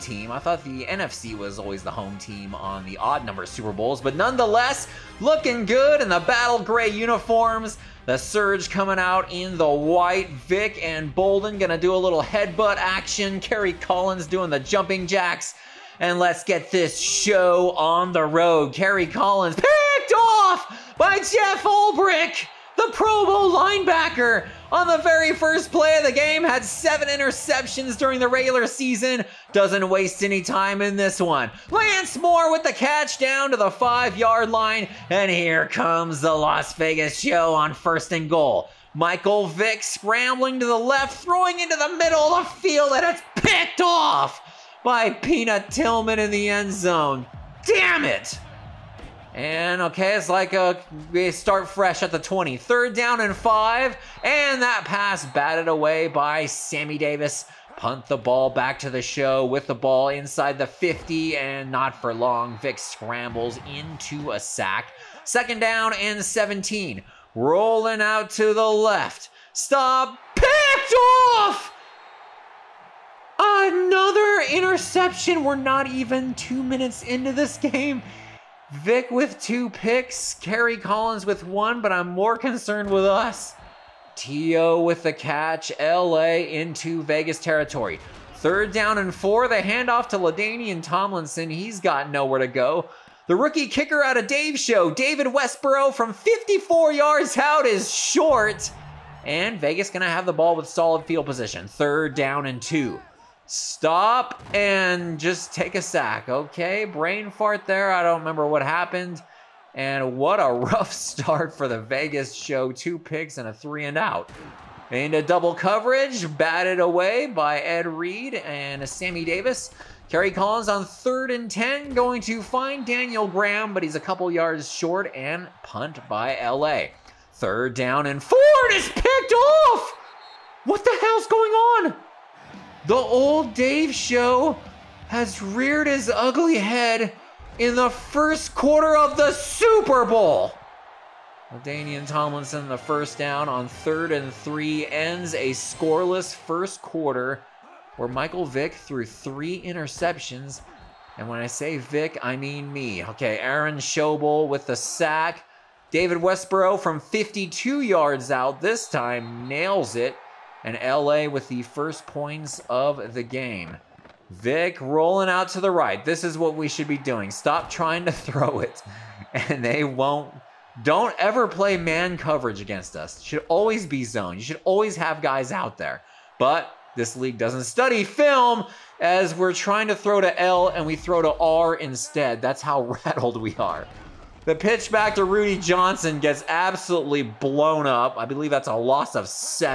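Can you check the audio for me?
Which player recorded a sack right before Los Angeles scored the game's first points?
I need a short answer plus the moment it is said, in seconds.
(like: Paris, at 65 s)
Aaron Schobel, at 153 s.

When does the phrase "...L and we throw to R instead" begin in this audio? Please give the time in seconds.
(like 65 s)
180 s.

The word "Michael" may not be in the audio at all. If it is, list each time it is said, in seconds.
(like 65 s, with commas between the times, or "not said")
38 s, 148 s.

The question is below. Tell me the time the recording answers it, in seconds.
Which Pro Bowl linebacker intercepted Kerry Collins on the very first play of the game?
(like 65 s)
21 s.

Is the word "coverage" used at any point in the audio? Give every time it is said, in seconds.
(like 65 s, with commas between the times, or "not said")
115 s, 172 s.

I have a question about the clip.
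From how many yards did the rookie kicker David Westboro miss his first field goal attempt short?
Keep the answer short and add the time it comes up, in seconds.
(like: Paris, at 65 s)
54, at 96 s.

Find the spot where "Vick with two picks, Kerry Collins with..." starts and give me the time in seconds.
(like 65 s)
78 s.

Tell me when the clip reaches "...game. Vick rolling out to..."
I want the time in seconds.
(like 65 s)
163 s.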